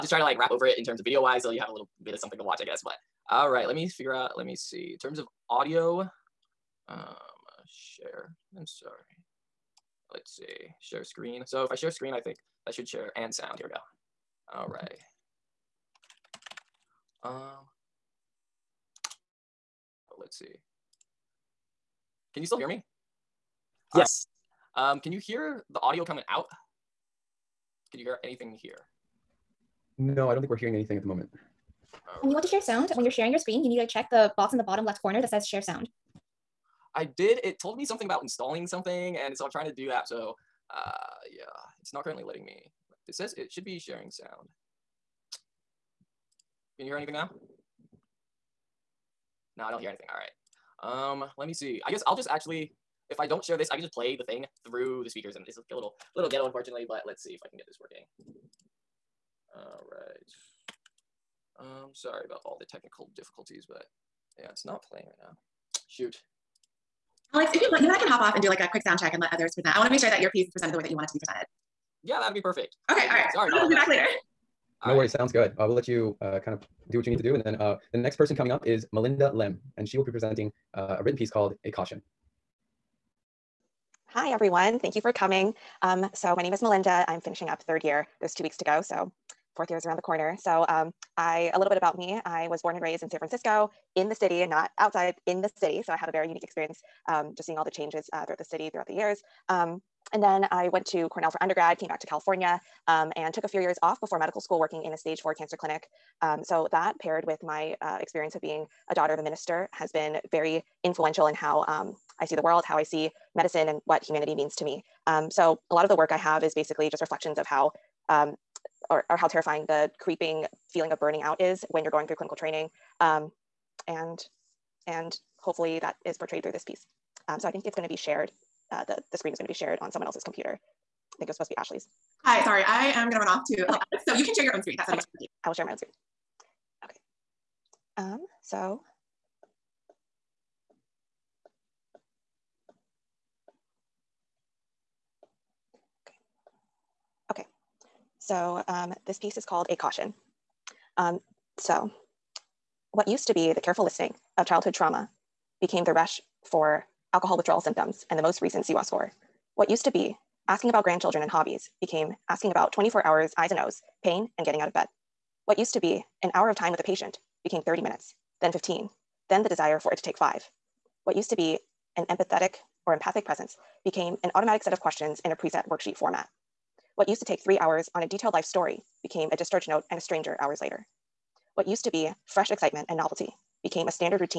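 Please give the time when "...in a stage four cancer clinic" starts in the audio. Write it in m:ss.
1:44.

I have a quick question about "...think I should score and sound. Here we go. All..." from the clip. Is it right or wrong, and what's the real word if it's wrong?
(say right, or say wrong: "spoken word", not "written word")
wrong: "share", not "score".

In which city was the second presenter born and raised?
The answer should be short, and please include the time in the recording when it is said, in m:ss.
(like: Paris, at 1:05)
San Francisco, at 1:33.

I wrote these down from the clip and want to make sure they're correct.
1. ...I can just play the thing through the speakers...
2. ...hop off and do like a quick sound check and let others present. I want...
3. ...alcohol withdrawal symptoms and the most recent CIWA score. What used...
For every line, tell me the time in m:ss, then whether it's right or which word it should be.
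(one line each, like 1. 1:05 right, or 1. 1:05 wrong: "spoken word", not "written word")
1. 0:53 right
2. 1:08 right
3. 2:37 right.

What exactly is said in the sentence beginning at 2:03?
Um, and, and hopefully that is portrayed through this piece.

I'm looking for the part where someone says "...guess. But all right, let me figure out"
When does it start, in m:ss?
0:02.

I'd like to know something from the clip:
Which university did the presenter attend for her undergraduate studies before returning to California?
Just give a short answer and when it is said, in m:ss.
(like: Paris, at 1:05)
Cornell, at 1:41.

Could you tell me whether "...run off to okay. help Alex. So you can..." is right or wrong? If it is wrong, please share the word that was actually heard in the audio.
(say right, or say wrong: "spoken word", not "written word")
right.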